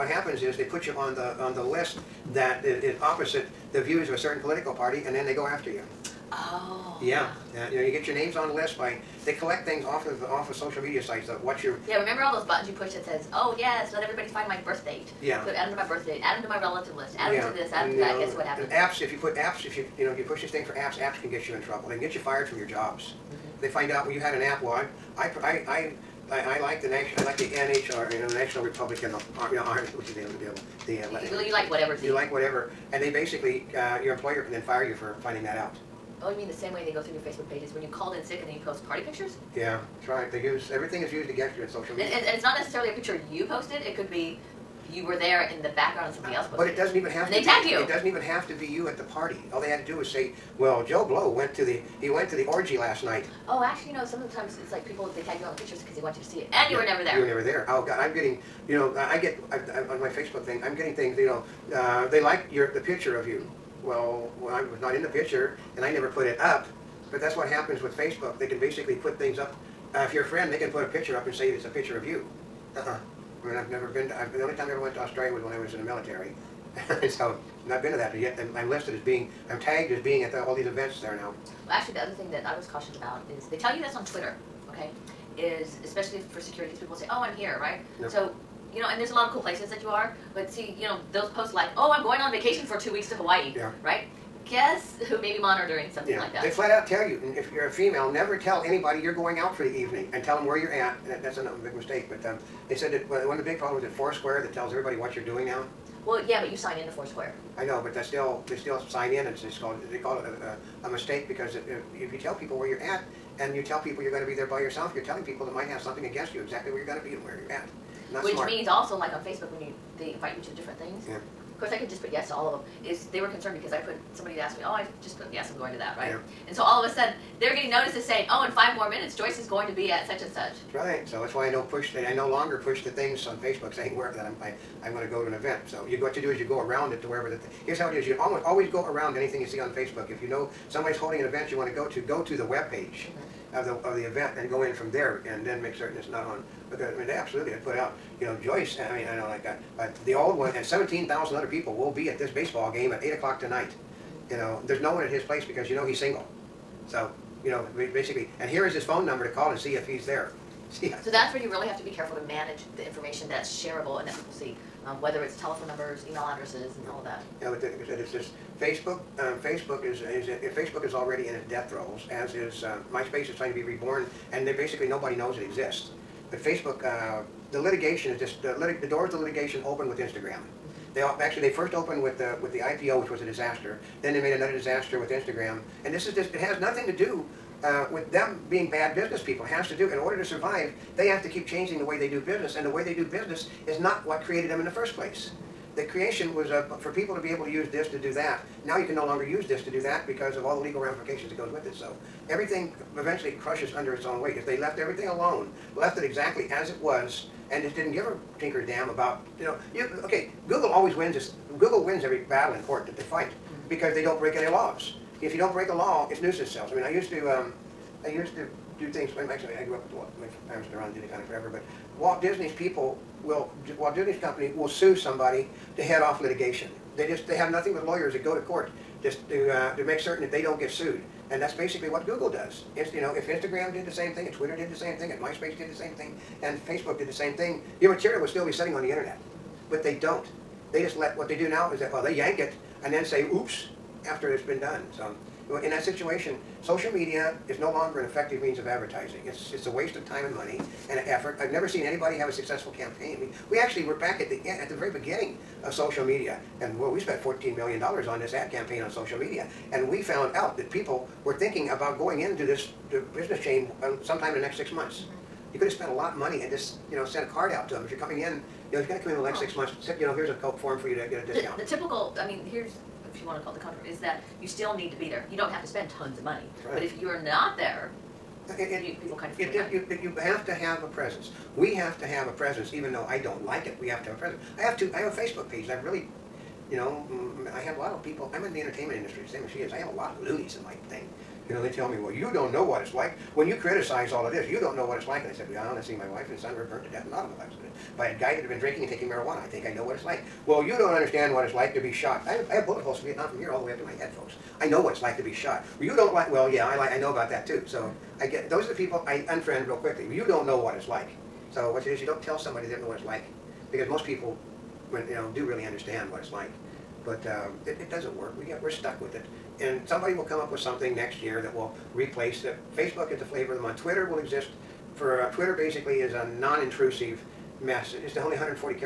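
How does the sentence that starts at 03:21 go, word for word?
So everything eventually crushes under its own weight.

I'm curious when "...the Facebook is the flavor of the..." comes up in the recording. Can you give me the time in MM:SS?
05:22.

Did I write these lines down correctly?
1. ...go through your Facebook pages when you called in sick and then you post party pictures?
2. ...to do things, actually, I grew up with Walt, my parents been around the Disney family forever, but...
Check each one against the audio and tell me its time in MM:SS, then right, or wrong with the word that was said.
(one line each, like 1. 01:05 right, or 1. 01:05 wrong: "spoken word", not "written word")
1. 00:36 right
2. 03:38 right.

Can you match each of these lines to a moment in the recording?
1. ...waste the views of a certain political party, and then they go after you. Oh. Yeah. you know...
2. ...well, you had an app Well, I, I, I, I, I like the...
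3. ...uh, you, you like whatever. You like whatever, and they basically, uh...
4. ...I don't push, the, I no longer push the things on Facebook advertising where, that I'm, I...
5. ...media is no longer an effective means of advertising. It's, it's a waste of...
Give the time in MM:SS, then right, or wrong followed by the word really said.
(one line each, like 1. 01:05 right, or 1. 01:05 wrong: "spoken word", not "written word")
1. 00:03 wrong: "opposite", not "waste"
2. 00:24 right
3. 00:31 right
4. 02:11 wrong: "saying", not "advertising"
5. 04:06 right.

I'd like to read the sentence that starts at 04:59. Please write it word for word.
I think I know what it's like.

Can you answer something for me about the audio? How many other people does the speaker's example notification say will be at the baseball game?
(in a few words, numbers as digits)
17,000.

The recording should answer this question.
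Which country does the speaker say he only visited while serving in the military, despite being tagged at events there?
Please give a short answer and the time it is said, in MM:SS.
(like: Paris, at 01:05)
Australia, at 01:14.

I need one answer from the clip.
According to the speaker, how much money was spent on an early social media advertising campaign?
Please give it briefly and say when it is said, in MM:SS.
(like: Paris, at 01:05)
$14 million, at 04:17.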